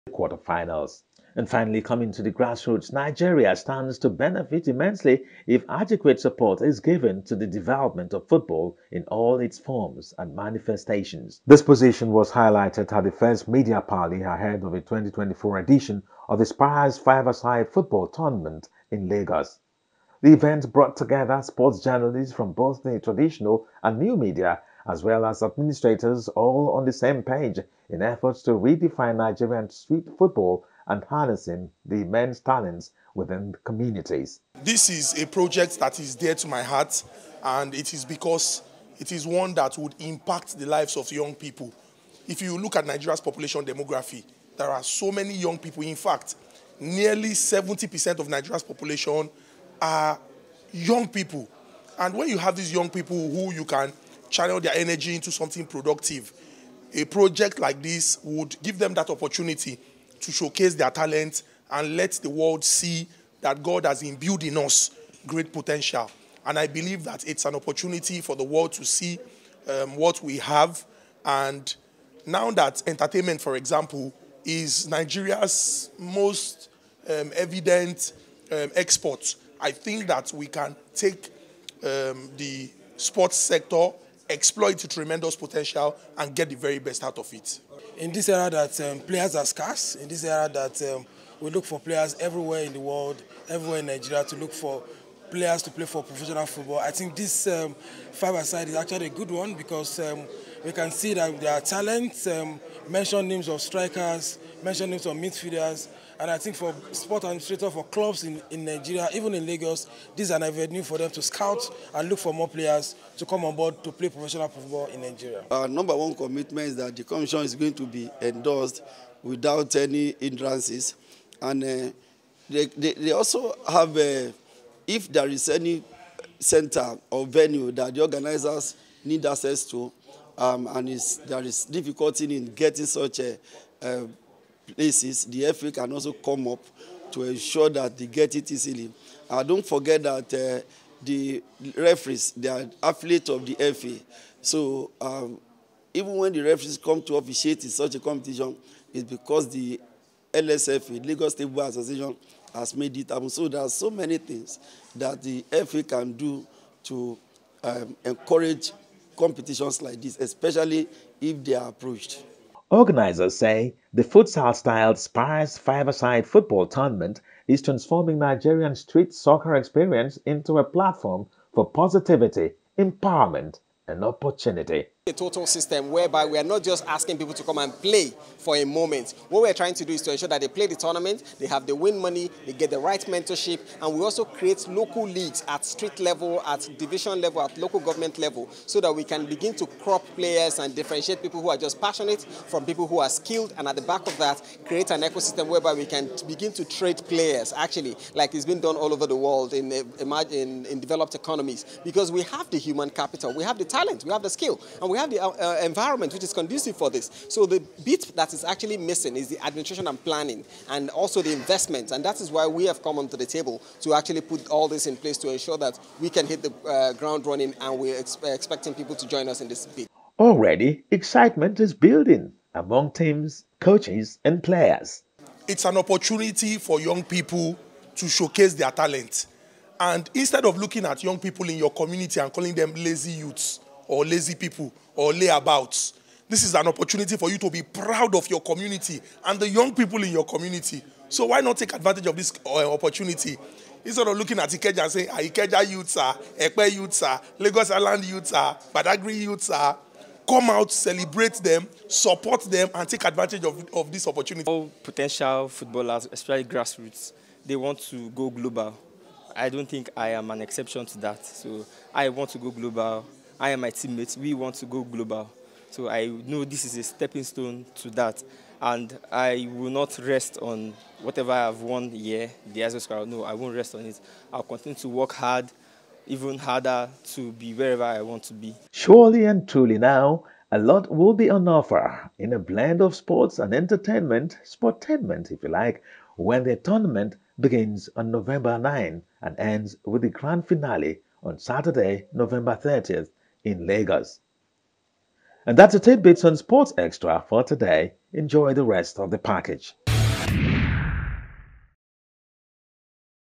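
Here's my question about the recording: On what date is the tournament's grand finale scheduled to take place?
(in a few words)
November 30.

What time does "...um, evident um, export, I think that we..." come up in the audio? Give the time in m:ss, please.
1:17.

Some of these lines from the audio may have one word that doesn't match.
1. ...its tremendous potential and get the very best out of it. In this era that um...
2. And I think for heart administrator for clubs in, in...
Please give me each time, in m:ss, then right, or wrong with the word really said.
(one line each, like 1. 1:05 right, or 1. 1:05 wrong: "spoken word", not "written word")
1. 1:24 right
2. 1:46 wrong: "sport", not "heart".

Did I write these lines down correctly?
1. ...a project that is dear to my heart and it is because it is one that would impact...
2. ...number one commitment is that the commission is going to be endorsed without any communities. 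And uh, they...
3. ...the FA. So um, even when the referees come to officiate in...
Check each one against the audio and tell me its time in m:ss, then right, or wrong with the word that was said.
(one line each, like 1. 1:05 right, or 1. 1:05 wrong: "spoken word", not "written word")
1. 0:35 right
2. 1:55 wrong: "hindrances", not "communities"
3. 2:23 right.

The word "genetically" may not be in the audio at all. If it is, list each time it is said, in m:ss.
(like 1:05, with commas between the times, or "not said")
not said.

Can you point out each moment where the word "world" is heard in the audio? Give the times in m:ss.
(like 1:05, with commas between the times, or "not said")
1:02, 1:08, 1:32.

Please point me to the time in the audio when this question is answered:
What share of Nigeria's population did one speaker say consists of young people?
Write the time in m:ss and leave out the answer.
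0:46.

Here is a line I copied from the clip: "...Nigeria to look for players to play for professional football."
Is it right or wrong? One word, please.
right.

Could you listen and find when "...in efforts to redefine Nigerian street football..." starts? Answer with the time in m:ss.
0:27.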